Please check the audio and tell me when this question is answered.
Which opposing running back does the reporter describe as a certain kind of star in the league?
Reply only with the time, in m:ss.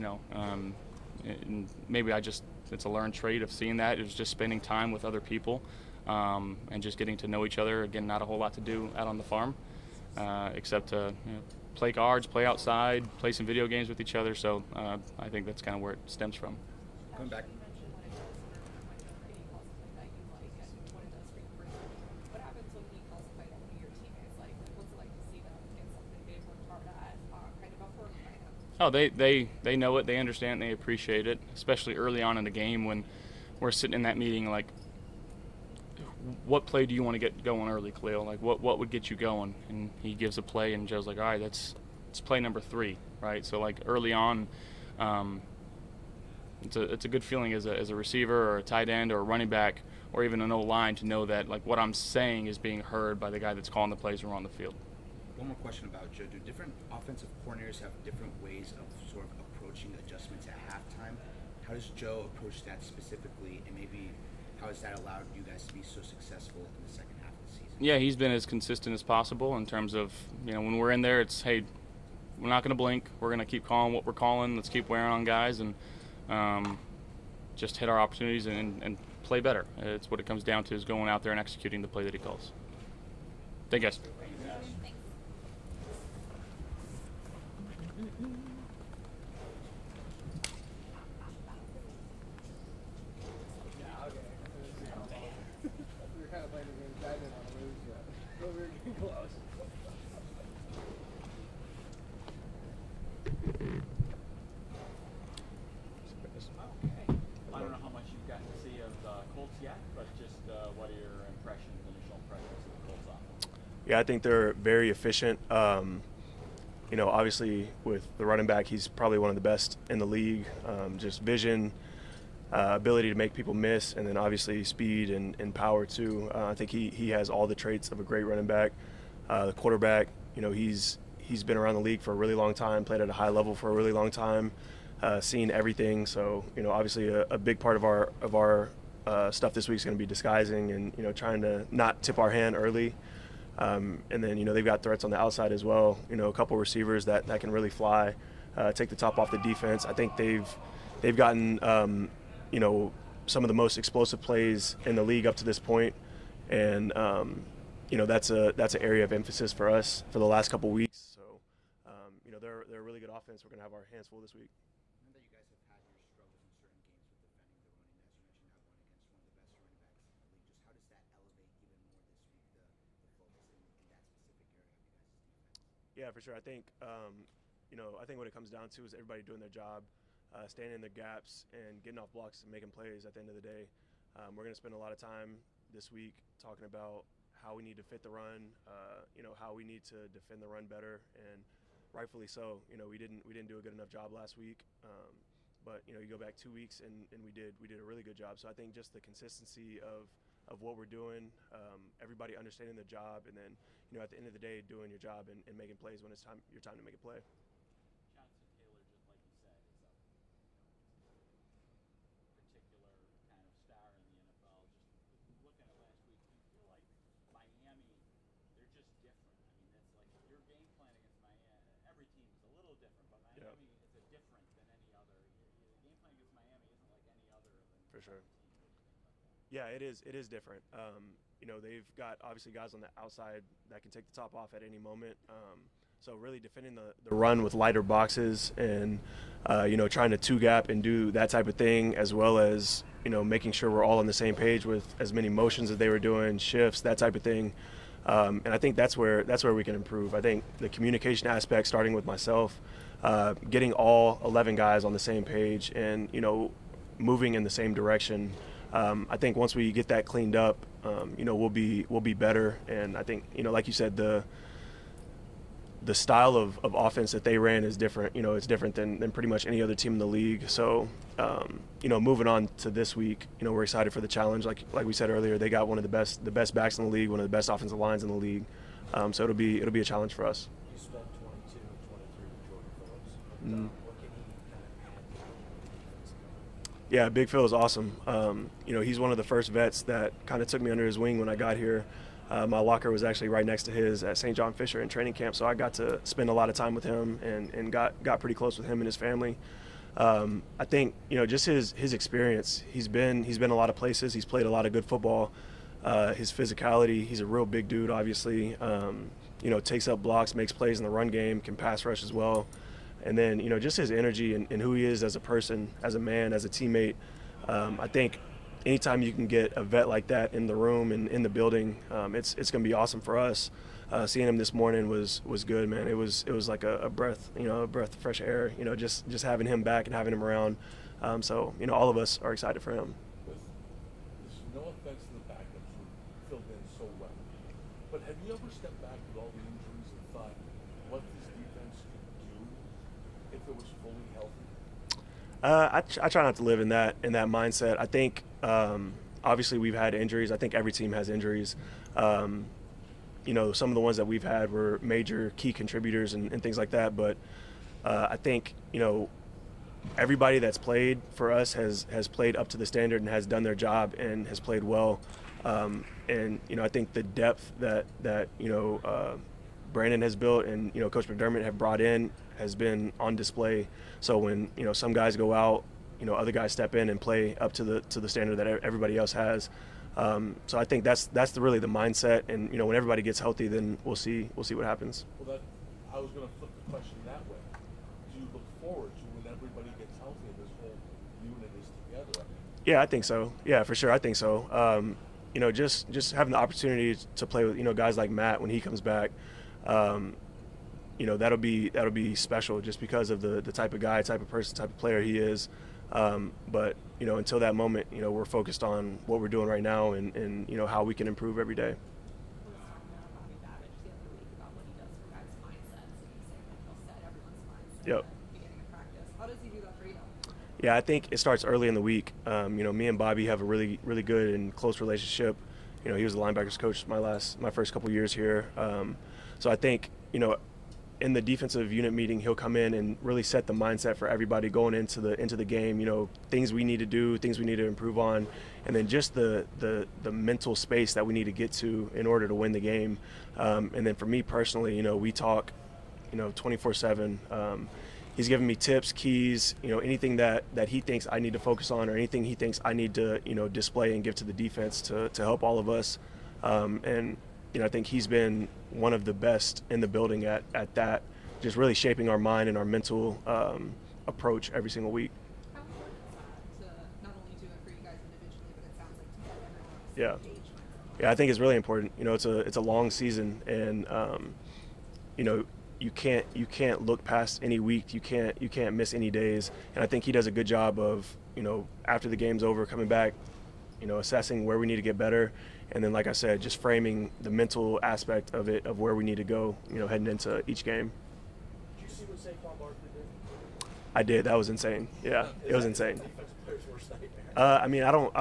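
3:28.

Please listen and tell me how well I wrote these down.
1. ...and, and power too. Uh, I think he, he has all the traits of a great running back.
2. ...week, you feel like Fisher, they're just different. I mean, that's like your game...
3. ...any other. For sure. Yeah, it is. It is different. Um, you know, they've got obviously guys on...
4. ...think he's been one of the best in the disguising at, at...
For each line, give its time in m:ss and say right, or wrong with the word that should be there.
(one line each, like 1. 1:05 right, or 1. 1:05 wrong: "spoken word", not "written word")
1. 2:05 right
2. 3:36 wrong: "Miami", not "Fisher"
3. 3:47 right
4. 7:37 wrong: "building", not "disguising".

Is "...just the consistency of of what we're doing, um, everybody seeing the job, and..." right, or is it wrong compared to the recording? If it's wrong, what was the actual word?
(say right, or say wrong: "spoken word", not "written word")
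wrong: "understanding", not "seeing".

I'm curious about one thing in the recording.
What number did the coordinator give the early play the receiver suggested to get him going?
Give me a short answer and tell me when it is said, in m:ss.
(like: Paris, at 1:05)
3, at 0:42.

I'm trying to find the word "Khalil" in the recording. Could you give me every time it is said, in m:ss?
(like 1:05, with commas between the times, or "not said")
0:37.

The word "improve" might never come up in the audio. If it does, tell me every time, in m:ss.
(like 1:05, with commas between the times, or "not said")
4:09, 6:51, 7:17.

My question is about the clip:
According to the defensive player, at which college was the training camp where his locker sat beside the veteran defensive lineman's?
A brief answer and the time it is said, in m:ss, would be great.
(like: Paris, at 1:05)
St. John Fisher, at 4:54.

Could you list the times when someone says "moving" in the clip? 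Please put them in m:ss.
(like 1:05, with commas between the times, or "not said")
4:16, 4:32.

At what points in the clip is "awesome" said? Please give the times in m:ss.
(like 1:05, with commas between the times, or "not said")
4:47, 5:22.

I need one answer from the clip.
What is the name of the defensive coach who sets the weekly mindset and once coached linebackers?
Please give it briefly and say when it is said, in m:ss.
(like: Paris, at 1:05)
Bobby, at 7:02.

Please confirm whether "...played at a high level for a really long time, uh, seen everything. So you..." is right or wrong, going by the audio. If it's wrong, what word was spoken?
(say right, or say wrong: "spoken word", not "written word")
right.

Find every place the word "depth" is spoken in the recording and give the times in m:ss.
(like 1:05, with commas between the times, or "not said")
6:07.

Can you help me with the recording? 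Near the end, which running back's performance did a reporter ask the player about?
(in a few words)
Saquon Barkley.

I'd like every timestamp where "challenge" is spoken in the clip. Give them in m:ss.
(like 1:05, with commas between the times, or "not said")
4:34, 4:39.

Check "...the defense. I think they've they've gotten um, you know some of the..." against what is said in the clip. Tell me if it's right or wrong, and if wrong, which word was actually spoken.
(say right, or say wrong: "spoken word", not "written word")
right.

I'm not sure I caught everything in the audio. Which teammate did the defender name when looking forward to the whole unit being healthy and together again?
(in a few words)
Matt.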